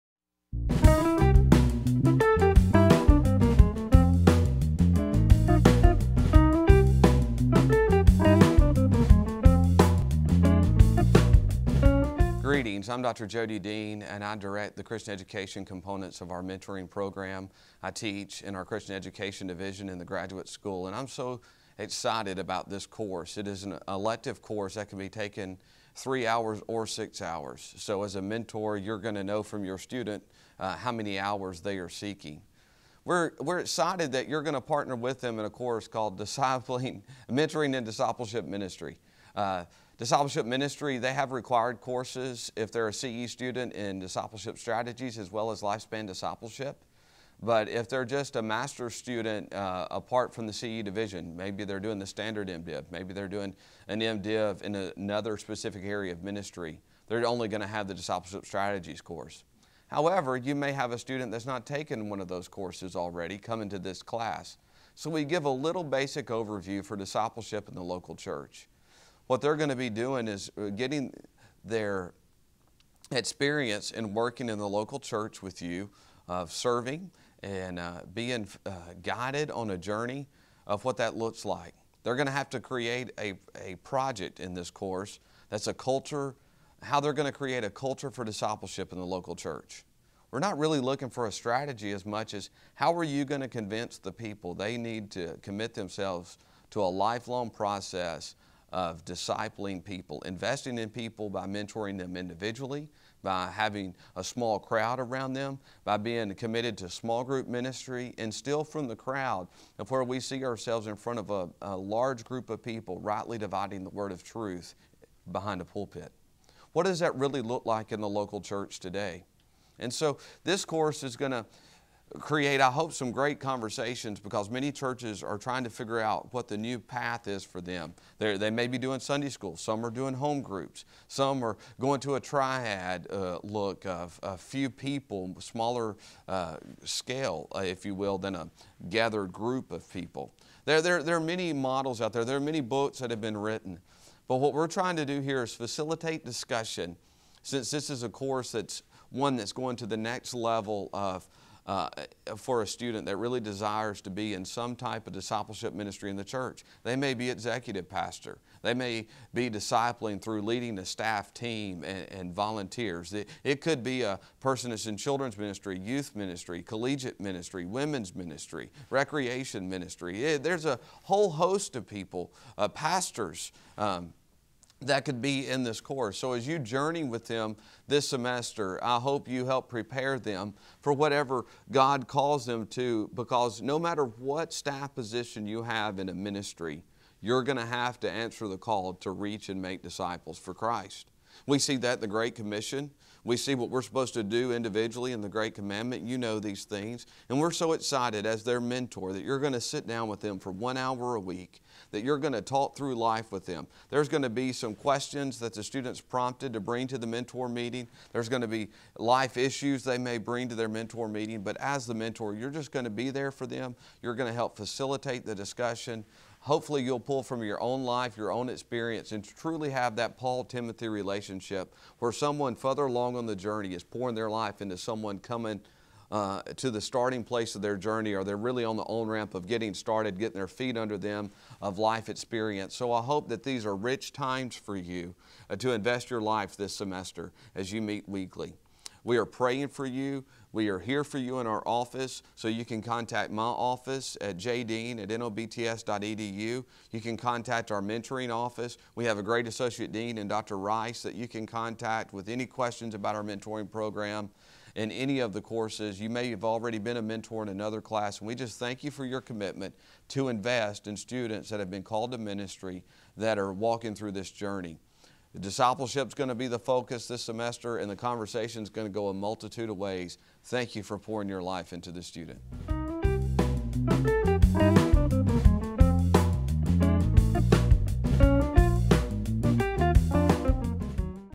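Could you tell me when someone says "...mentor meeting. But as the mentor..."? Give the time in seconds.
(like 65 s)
210 s.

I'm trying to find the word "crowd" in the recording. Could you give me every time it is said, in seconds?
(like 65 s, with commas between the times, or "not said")
104 s, 108 s.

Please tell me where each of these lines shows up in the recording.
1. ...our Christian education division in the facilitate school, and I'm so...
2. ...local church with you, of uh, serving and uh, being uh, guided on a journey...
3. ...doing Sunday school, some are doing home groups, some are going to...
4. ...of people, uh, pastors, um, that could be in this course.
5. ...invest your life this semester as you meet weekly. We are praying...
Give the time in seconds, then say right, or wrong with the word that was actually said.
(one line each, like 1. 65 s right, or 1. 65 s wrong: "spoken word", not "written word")
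1. 18 s wrong: "graduate", not "facilitate"
2. 74 s right
3. 128 s right
4. 171 s right
5. 235 s right.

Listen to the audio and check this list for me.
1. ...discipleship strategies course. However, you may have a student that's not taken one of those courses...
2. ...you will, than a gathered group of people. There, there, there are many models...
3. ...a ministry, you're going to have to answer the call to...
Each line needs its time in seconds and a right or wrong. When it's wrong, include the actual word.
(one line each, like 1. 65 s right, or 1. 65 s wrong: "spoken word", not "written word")
1. 57 s right
2. 137 s right
3. 186 s right.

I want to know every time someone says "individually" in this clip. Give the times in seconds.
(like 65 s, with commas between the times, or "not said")
102 s, 194 s.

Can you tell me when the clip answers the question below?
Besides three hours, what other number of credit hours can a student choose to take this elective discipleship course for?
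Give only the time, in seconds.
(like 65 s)
26 s.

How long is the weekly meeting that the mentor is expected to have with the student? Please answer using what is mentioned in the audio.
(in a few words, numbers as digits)
1 hour.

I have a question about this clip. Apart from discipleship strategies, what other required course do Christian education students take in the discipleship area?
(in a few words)
Lifespan discipleship.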